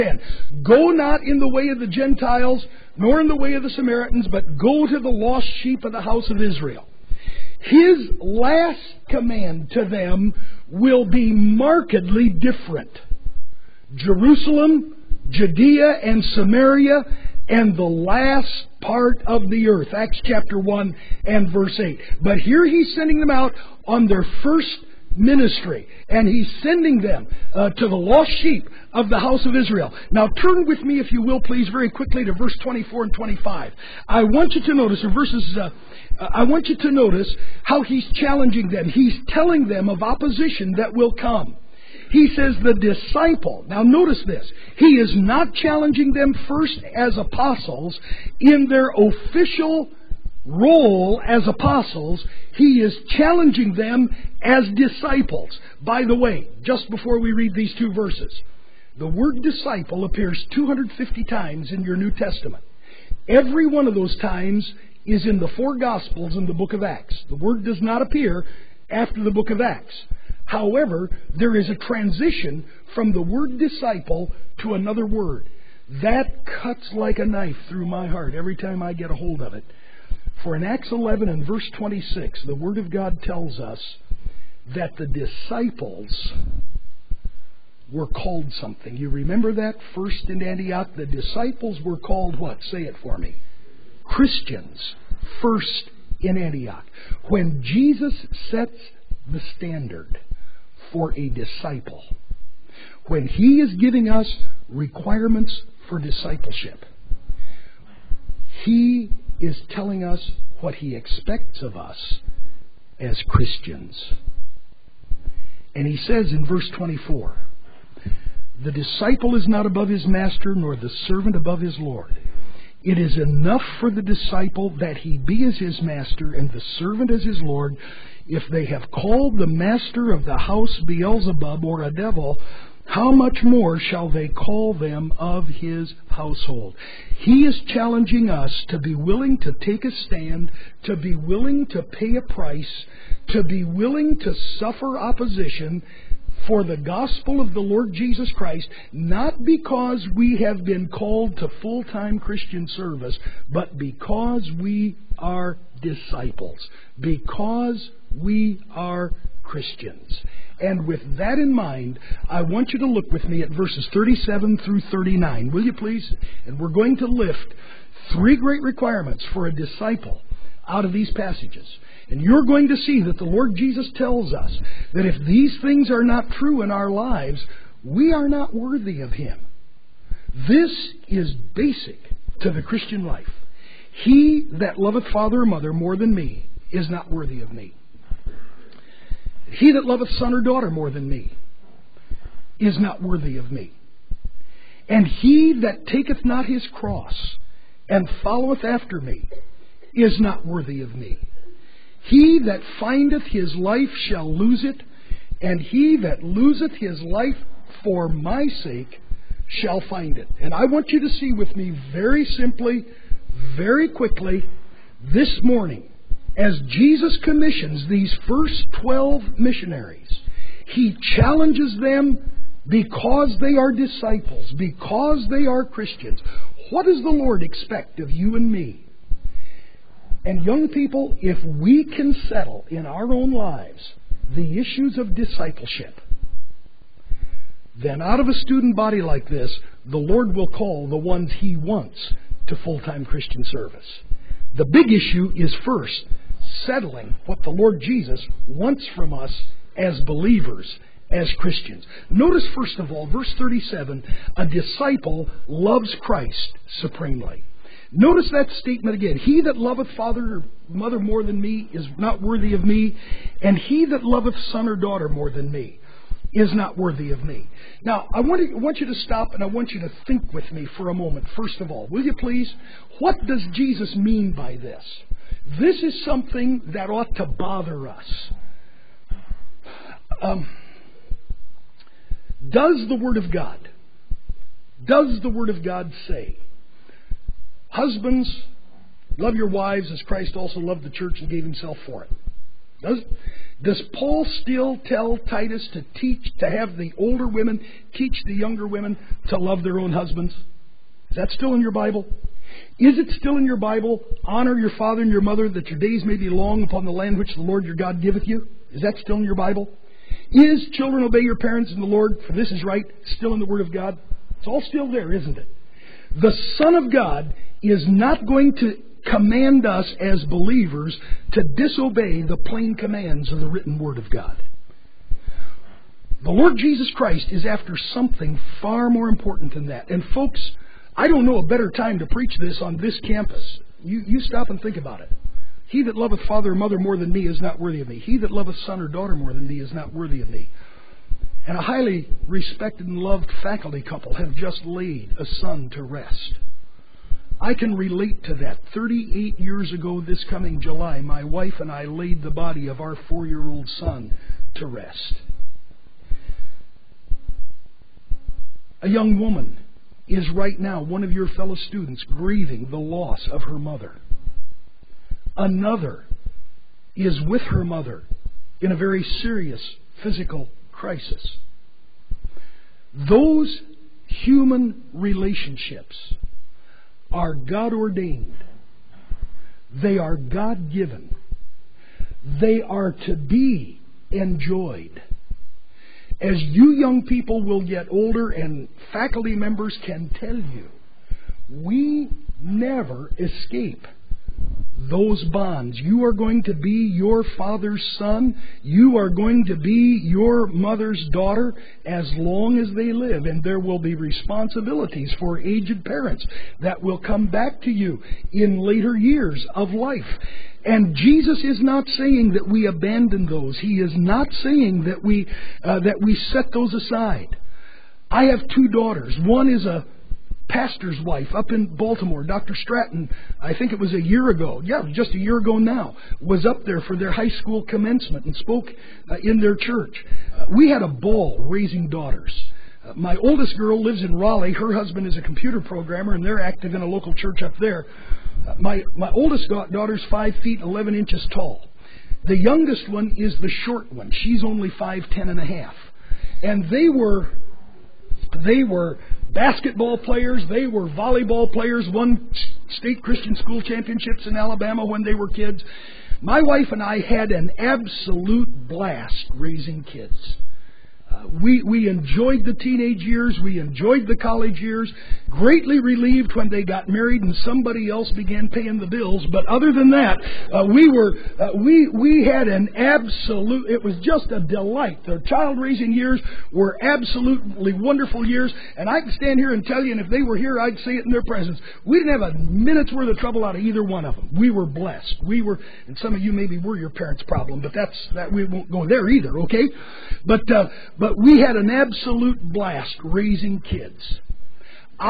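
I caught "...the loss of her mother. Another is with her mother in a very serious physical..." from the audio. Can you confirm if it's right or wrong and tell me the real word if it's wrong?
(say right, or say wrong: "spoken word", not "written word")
right.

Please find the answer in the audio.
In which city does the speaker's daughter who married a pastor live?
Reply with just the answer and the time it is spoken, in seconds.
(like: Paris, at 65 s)
Baltimore, at 421 s.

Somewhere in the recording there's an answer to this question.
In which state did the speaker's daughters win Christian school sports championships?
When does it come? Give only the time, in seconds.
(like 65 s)
454 s.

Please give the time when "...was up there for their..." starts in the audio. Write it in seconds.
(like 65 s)
426 s.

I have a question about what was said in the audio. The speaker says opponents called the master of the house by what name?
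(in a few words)
Beelzebub.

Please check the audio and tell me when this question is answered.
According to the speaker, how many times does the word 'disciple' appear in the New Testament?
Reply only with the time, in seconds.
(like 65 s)
60 s.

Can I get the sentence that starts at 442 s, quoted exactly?
The youngest one is the short one.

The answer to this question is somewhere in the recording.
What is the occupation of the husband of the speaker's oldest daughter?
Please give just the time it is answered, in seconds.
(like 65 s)
435 s.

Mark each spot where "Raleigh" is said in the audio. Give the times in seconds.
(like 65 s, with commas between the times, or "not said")
434 s.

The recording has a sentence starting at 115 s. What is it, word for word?
And He says in verse 24, the disciple is not above his master, nor the servant above his Lord.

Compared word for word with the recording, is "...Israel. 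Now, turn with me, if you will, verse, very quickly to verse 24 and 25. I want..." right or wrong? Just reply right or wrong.
wrong.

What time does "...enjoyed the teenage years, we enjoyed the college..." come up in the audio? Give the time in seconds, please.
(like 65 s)
461 s.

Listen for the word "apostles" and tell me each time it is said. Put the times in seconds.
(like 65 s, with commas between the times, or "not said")
47 s, 51 s.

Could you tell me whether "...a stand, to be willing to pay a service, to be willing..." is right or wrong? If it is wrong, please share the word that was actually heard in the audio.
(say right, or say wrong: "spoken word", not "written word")
wrong: "price", not "service".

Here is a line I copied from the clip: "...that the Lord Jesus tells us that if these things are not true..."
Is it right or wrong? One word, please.
right.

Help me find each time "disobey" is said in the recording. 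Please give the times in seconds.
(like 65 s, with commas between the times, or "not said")
321 s.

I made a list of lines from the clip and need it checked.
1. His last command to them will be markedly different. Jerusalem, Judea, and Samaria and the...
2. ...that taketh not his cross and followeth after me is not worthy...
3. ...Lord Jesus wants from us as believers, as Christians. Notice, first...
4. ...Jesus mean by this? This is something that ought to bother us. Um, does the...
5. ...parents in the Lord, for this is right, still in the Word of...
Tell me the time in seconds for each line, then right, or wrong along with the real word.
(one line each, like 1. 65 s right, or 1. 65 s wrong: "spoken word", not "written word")
1. 7 s right
2. 195 s right
3. 247 s right
4. 273 s right
5. 311 s right.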